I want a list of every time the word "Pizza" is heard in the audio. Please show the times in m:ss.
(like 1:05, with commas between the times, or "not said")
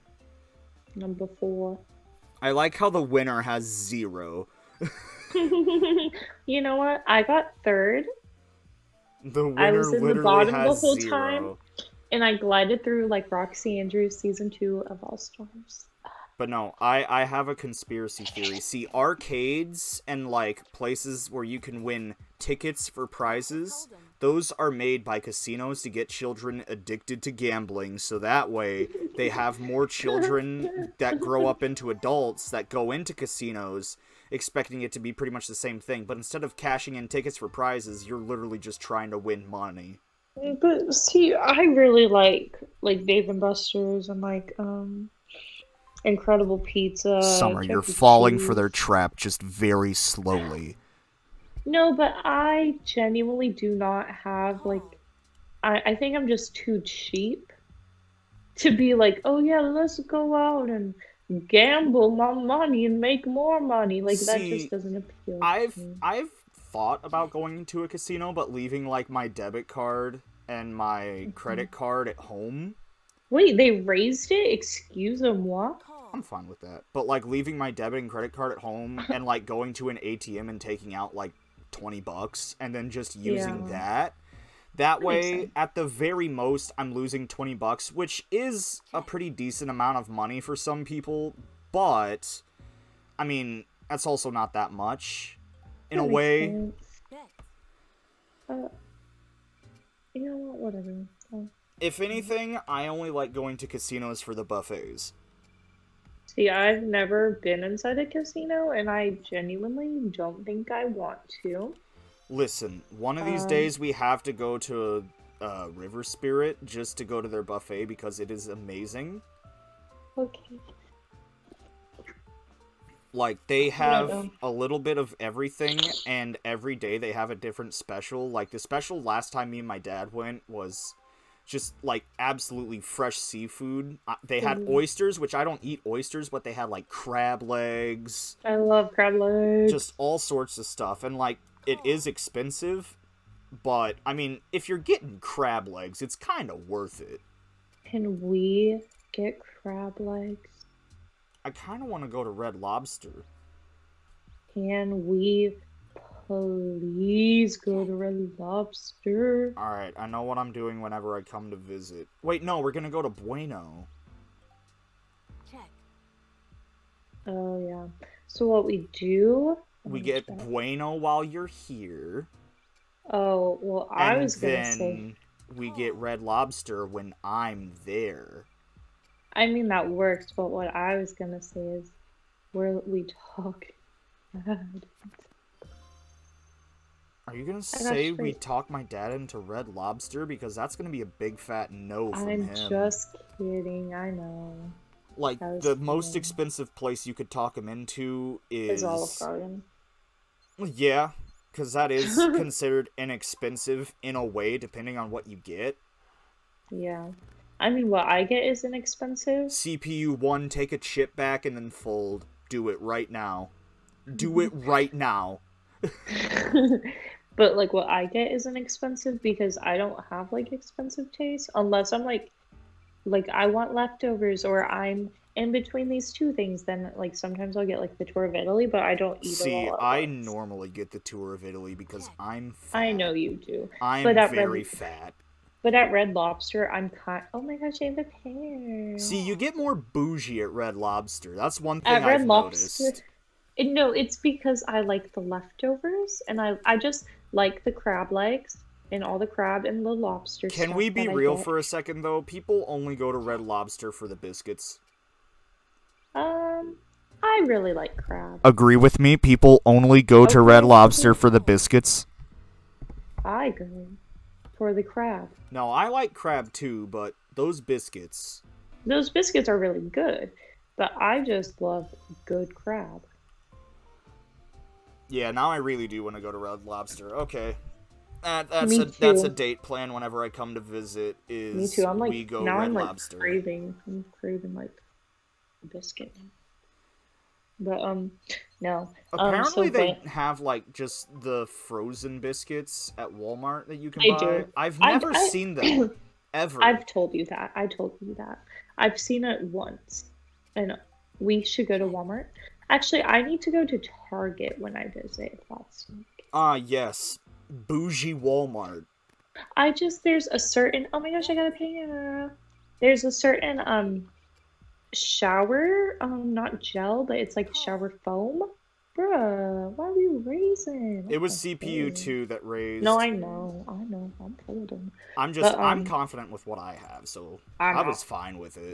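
0:46.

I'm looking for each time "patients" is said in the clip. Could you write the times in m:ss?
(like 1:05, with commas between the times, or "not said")
not said.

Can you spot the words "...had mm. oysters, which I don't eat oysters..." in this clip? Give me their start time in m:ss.
2:14.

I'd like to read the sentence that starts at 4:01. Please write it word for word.
That's one thing at I've Lobster, noticed.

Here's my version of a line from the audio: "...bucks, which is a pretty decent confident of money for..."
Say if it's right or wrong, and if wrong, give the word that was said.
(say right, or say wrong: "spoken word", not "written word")
wrong: "amount", not "confident".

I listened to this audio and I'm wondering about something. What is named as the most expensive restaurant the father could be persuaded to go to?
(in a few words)
Olive Garden.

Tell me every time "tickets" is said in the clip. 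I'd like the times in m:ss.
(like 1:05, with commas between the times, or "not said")
0:22, 0:37.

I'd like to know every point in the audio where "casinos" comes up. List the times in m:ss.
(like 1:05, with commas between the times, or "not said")
0:25, 0:33, 1:07, 1:43, 1:48.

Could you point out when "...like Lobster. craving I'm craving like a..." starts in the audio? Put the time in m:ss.
4:42.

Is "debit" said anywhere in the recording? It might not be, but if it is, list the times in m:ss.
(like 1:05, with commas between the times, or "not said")
1:09, 1:17.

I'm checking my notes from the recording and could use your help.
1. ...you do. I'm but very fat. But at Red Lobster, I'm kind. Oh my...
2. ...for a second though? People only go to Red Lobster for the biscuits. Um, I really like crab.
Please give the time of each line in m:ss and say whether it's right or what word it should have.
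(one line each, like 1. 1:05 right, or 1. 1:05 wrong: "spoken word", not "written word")
1. 3:53 right
2. 4:11 right.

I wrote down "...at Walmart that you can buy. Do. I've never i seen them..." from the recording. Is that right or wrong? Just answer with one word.
right.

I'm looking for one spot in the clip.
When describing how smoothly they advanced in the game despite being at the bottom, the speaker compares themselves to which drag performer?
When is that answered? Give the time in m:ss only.
0:13.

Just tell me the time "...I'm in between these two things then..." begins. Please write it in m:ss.
3:44.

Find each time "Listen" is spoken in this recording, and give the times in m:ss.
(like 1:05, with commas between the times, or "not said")
1:52.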